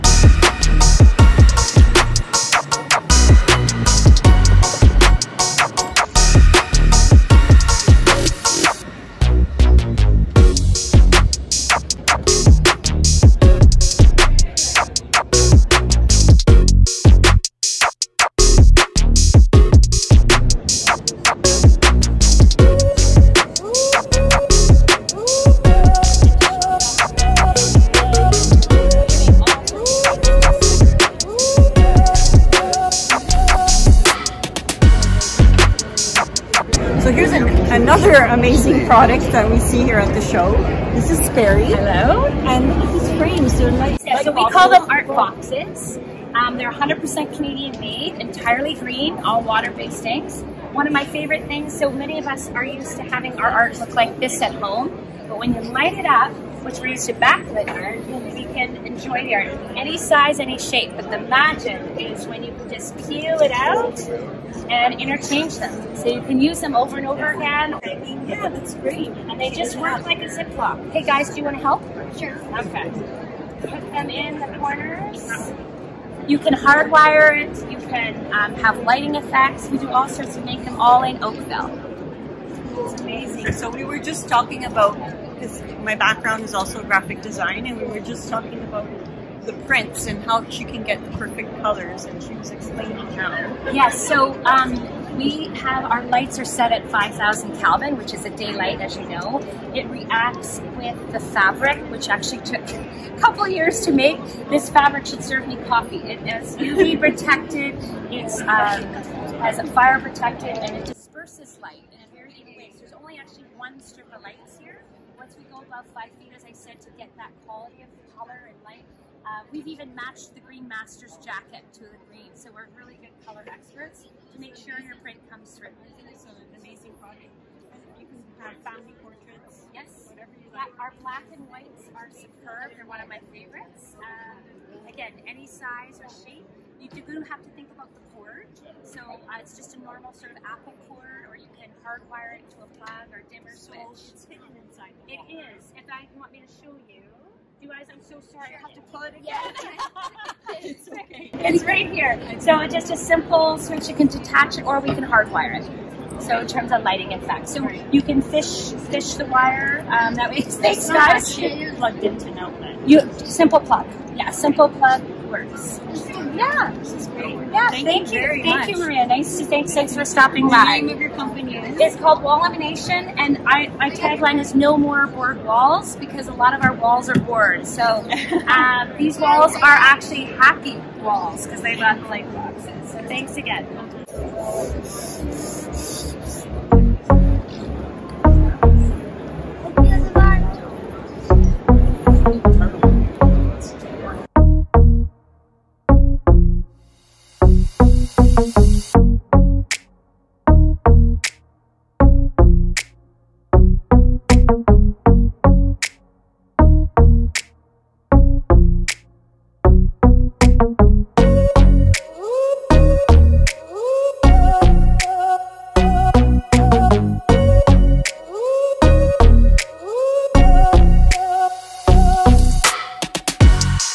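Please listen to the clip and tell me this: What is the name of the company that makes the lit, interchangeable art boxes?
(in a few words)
Wallumination.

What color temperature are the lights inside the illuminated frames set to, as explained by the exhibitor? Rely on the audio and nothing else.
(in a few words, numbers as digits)
5,000 Kelvin.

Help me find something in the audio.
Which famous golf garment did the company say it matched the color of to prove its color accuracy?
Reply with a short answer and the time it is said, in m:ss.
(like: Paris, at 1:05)
Green Master's jacket, at 2:00.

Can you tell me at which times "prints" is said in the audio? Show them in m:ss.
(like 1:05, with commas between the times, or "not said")
1:29, 2:05.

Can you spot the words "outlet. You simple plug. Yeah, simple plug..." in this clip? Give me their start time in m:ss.
2:42.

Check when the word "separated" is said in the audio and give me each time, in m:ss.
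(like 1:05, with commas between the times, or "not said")
not said.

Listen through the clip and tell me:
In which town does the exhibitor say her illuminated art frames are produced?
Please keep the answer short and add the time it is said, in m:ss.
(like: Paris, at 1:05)
Oakville, at 1:21.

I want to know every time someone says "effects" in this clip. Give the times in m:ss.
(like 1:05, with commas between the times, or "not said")
1:19, 2:37.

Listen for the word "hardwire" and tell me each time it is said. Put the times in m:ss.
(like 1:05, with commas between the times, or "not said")
1:16, 2:21, 2:35.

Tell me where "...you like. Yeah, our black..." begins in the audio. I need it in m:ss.
2:10.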